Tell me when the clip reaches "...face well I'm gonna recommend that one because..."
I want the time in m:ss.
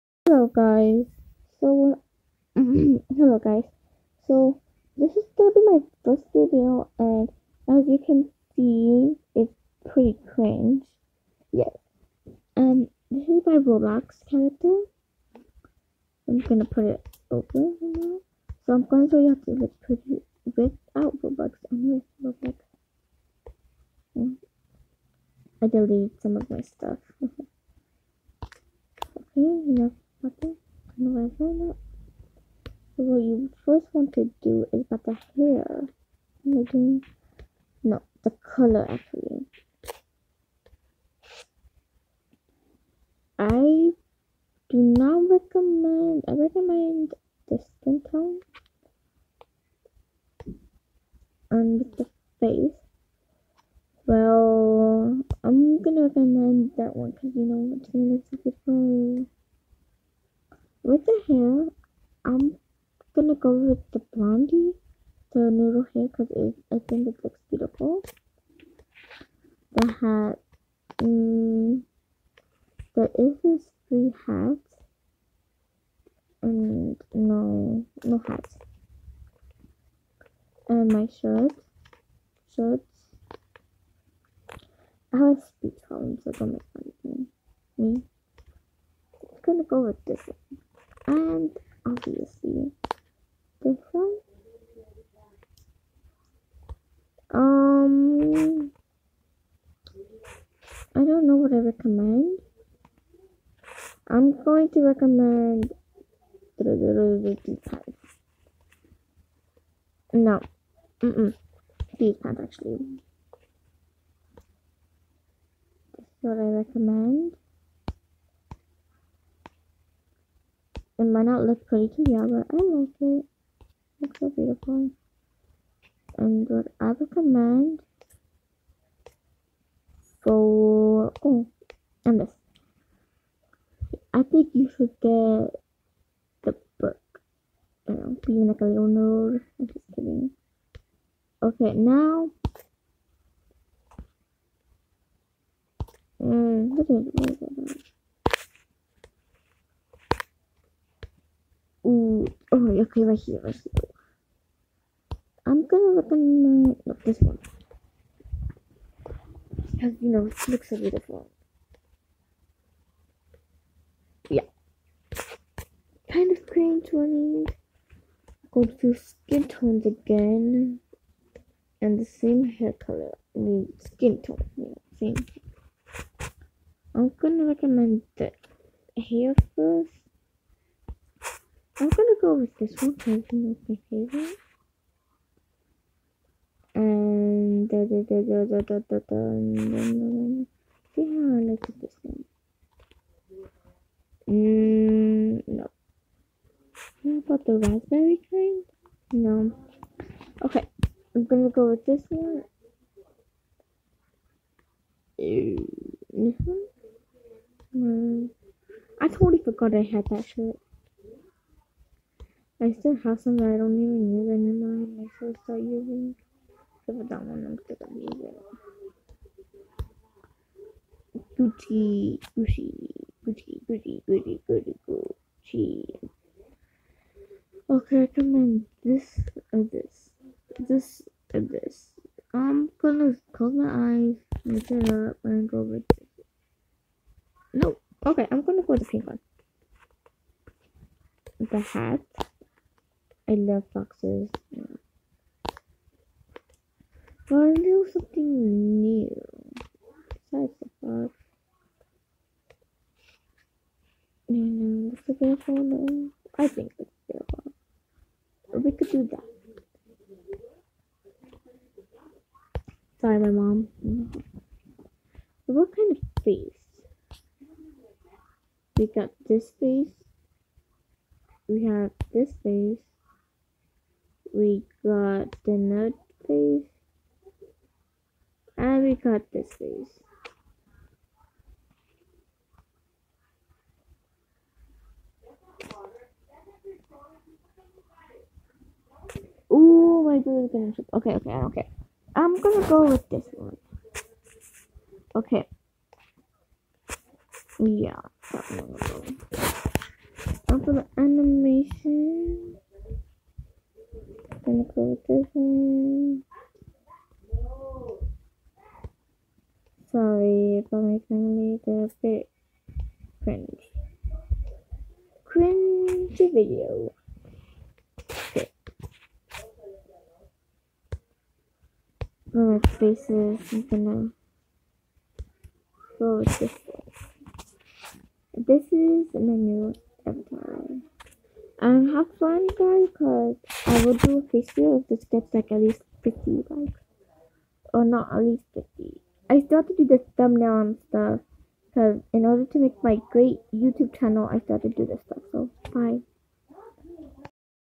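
0:52.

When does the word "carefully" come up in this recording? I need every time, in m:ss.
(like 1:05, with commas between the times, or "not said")
not said.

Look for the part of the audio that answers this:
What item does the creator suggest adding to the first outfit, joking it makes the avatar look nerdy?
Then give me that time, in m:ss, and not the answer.
2:16.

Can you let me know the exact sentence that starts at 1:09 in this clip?
The hat, um, there is this three hats, and no, no hats.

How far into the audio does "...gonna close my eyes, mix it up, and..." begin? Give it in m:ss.
3:52.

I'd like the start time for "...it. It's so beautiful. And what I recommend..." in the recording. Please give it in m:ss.
2:03.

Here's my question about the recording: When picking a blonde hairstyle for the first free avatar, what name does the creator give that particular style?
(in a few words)
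noodle hair.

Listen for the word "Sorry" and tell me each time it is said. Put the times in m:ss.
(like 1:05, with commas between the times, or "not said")
4:22, 5:09.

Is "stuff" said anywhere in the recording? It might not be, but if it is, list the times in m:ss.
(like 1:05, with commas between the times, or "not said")
0:26, 5:40, 5:45.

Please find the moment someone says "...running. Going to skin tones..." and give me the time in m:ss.
2:46.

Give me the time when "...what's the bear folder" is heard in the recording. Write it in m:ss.
4:14.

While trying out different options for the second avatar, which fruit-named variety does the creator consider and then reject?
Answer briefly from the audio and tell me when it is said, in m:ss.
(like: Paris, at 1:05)
raspberry, at 3:17.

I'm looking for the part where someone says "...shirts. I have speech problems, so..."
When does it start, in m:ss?
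1:22.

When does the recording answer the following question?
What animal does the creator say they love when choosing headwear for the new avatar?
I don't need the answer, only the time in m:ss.
4:03.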